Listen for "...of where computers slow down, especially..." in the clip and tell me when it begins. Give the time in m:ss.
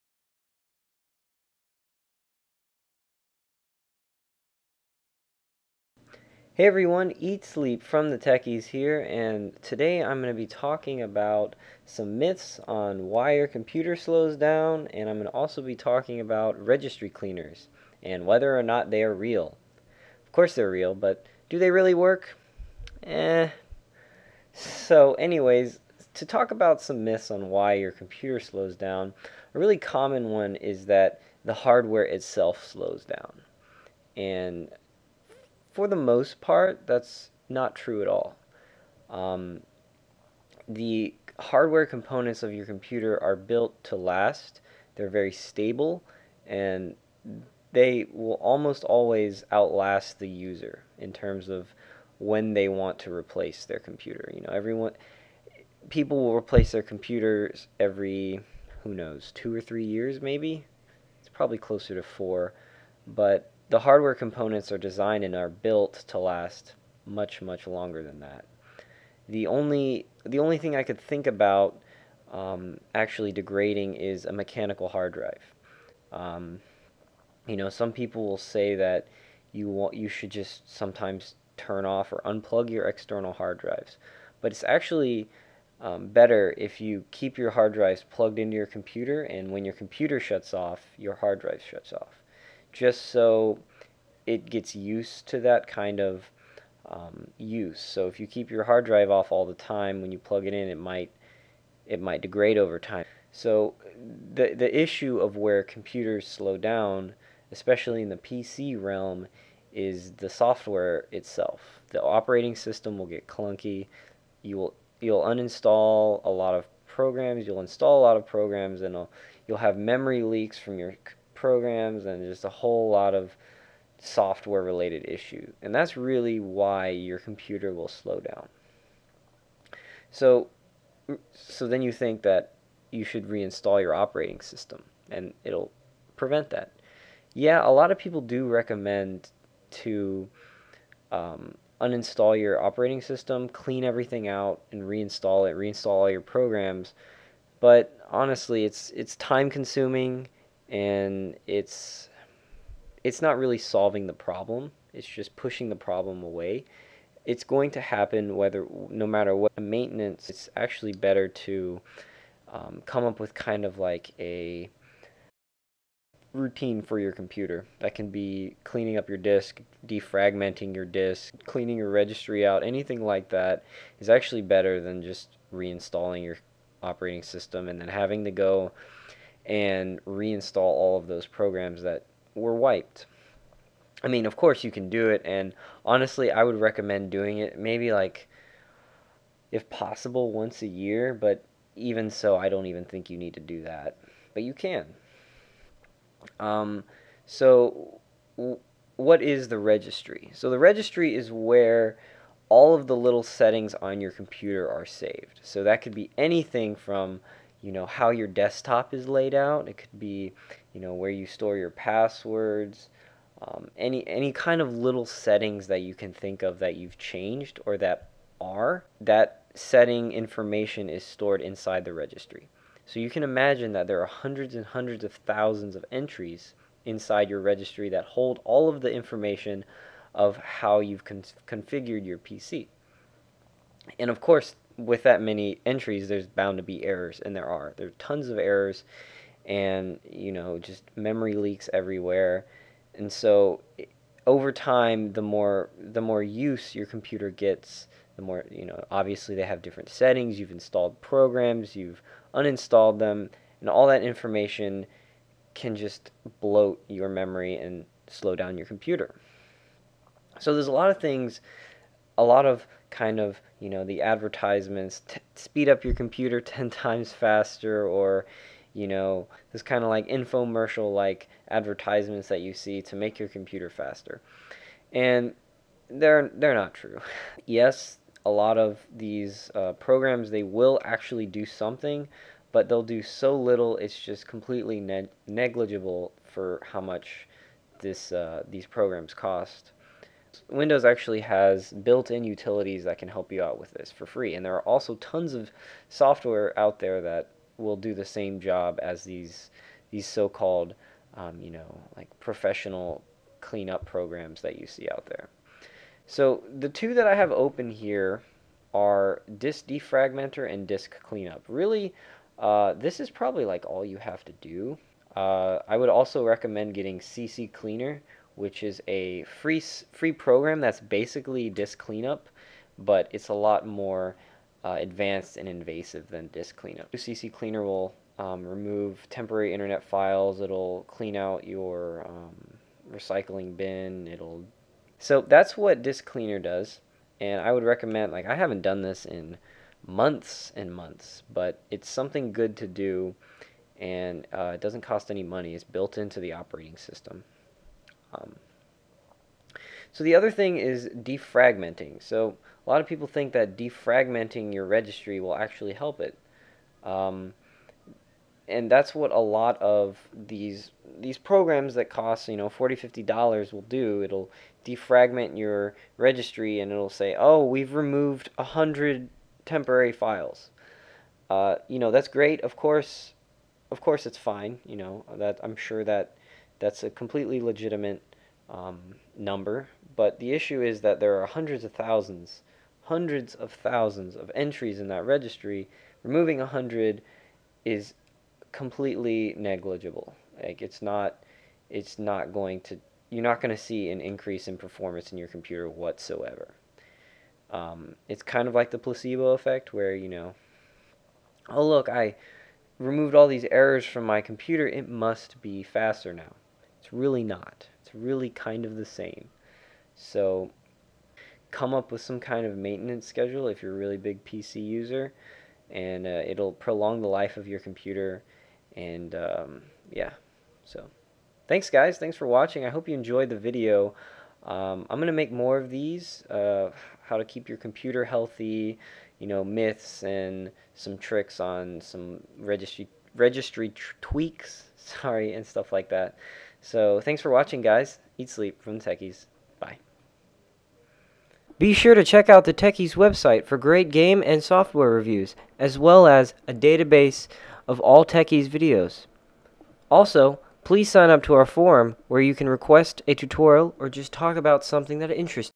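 1:45.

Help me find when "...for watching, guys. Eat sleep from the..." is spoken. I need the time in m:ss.
7:17.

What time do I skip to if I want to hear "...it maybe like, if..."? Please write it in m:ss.
3:07.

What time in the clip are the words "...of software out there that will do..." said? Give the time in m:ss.
4:55.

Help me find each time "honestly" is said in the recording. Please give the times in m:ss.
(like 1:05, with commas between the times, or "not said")
2:28, 3:05.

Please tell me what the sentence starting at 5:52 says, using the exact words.
So a lot of people think that defragmenting your registry will actually help it.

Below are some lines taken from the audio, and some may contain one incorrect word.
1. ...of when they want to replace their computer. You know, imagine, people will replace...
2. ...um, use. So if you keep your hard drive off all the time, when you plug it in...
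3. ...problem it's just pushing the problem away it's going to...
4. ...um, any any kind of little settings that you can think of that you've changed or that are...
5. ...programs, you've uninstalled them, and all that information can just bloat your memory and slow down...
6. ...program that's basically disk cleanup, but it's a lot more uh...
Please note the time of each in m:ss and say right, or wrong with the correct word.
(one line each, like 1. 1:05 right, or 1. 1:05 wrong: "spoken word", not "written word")
1. 0:51 wrong: "everyone", not "imagine"
2. 1:36 right
3. 2:34 right
4. 3:33 right
5. 4:11 right
6. 5:20 right.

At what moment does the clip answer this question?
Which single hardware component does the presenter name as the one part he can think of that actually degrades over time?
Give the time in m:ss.
1:14.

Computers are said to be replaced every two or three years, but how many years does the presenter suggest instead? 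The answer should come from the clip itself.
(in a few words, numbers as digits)
4.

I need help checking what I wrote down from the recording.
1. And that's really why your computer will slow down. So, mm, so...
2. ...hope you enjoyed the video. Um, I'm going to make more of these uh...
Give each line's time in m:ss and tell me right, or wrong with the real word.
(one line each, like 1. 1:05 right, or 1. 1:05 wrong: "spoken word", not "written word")
1. 2:05 right
2. 7:02 right.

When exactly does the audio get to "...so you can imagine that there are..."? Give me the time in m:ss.
3:42.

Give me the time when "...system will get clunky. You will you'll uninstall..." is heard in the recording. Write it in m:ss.
1:52.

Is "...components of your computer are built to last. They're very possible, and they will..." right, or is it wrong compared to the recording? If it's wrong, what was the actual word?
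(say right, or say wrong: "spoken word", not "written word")
wrong: "stable", not "possible".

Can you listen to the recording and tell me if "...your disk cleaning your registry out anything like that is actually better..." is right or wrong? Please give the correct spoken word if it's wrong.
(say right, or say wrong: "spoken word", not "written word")
right.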